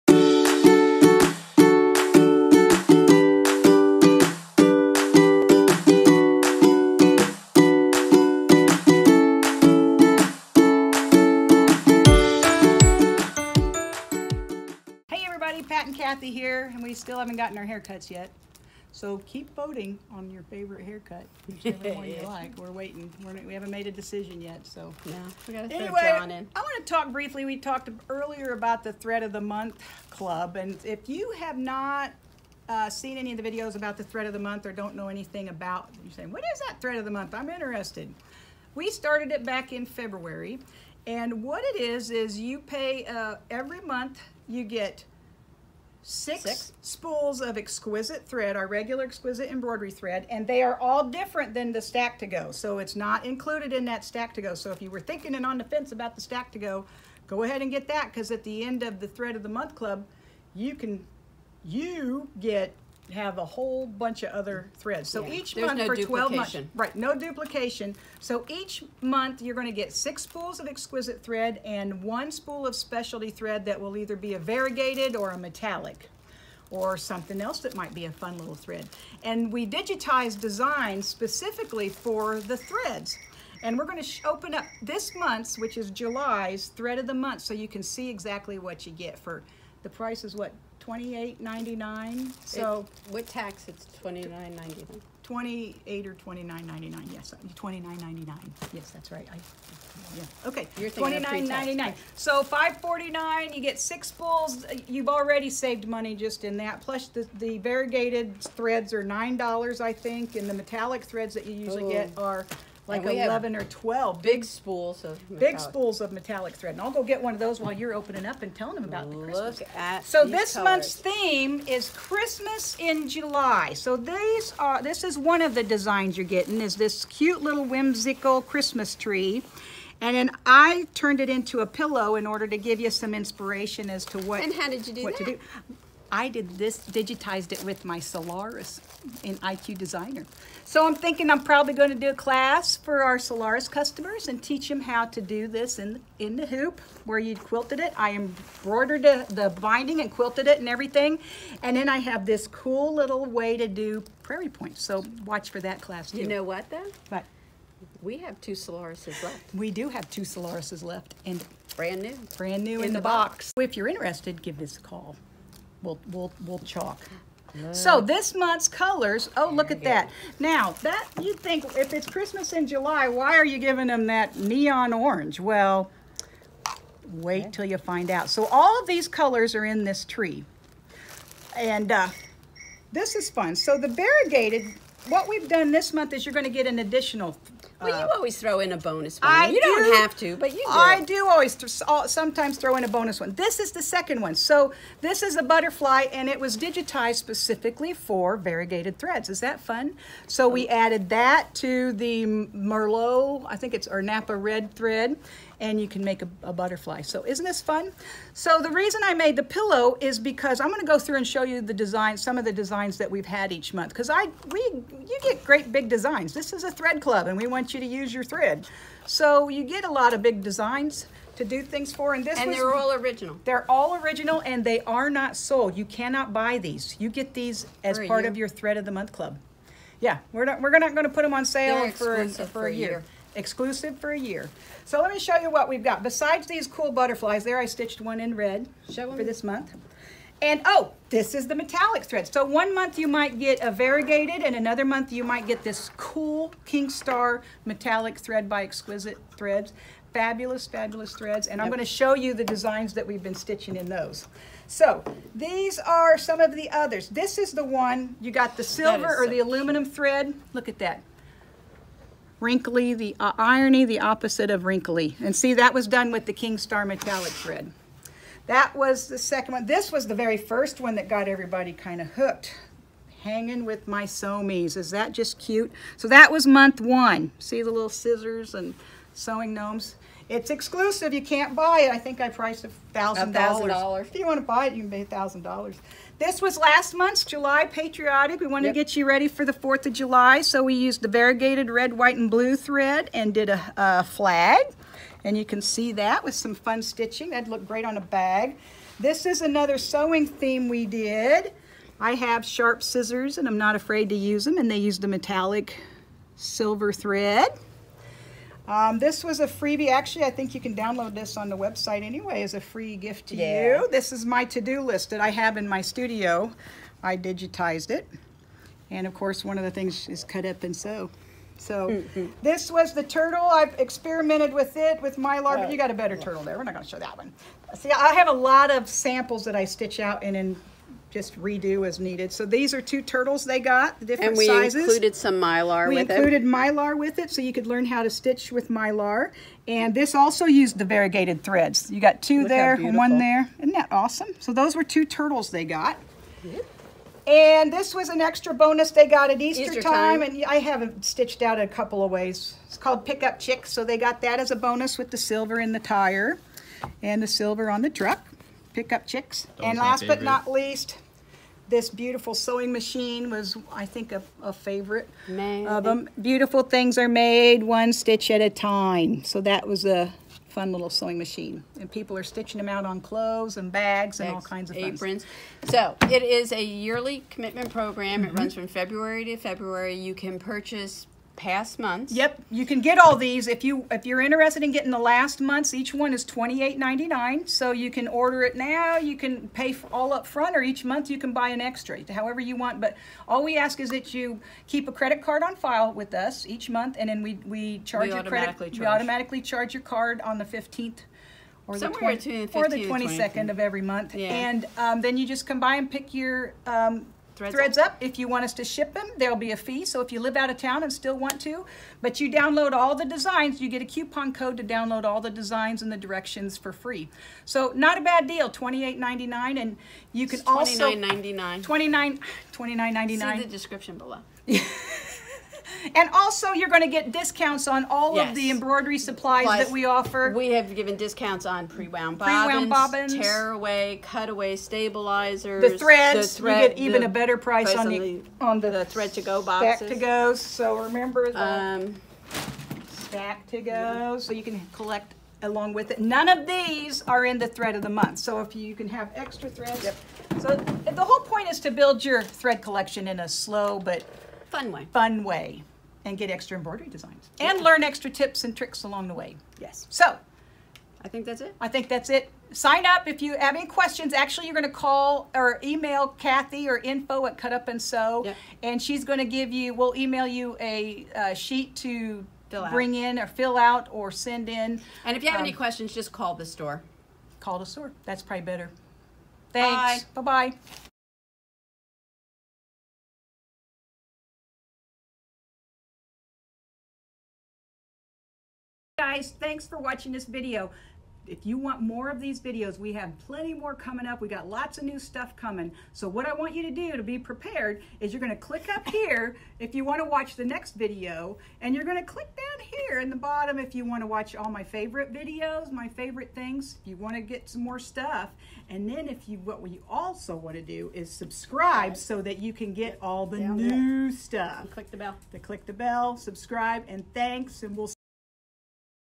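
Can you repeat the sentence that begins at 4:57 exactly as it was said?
That'd look great on a bag.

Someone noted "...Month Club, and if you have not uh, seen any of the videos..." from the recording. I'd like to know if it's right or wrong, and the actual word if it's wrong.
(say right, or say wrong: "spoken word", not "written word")
right.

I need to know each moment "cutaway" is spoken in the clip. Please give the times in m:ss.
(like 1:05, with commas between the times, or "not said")
7:14.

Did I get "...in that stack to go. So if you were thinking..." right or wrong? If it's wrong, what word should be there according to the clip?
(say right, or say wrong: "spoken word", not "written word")
right.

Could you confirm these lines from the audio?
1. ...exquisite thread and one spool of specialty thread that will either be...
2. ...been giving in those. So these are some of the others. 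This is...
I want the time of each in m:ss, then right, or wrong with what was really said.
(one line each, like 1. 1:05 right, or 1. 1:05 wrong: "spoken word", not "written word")
1. 1:10 right
2. 4:13 wrong: "stitching", not "giving".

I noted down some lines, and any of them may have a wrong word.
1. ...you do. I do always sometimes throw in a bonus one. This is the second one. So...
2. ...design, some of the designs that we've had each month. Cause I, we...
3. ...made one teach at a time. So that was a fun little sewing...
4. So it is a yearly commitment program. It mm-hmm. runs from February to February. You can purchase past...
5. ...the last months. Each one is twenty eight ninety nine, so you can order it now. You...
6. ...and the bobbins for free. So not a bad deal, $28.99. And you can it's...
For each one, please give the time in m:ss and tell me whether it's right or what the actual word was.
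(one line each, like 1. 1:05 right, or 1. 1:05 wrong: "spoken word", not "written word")
1. 3:10 right
2. 3:31 right
3. 6:07 wrong: "stitch", not "teach"
4. 6:15 right
5. 6:24 right
6. 6:55 wrong: "directions", not "bobbins".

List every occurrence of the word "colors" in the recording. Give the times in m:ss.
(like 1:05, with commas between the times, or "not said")
2:00, 2:48, 2:59.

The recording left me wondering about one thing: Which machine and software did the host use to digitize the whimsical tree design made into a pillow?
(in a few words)
Solaris in IQ Designer.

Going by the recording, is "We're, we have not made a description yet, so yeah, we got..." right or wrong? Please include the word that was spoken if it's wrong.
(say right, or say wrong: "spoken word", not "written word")
wrong: "decision", not "description".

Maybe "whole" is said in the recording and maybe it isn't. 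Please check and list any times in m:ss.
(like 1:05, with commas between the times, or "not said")
1:03, 7:31.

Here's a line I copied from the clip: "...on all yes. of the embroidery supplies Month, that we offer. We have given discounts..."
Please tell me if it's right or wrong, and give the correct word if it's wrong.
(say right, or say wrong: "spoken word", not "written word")
wrong: "Plus", not "Month".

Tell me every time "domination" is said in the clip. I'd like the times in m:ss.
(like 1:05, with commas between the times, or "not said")
not said.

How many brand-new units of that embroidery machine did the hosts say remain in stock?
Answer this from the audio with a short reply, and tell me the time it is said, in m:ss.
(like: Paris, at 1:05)
2, at 2:38.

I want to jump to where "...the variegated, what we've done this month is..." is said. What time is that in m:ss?
3:03.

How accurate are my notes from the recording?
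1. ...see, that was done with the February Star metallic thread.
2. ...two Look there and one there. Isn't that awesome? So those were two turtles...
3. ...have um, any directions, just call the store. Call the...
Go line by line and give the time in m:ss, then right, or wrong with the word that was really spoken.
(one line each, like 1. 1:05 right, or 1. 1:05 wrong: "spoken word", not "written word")
1. 4:25 wrong: "King", not "February"
2. 5:42 right
3. 7:55 wrong: "questions", not "directions".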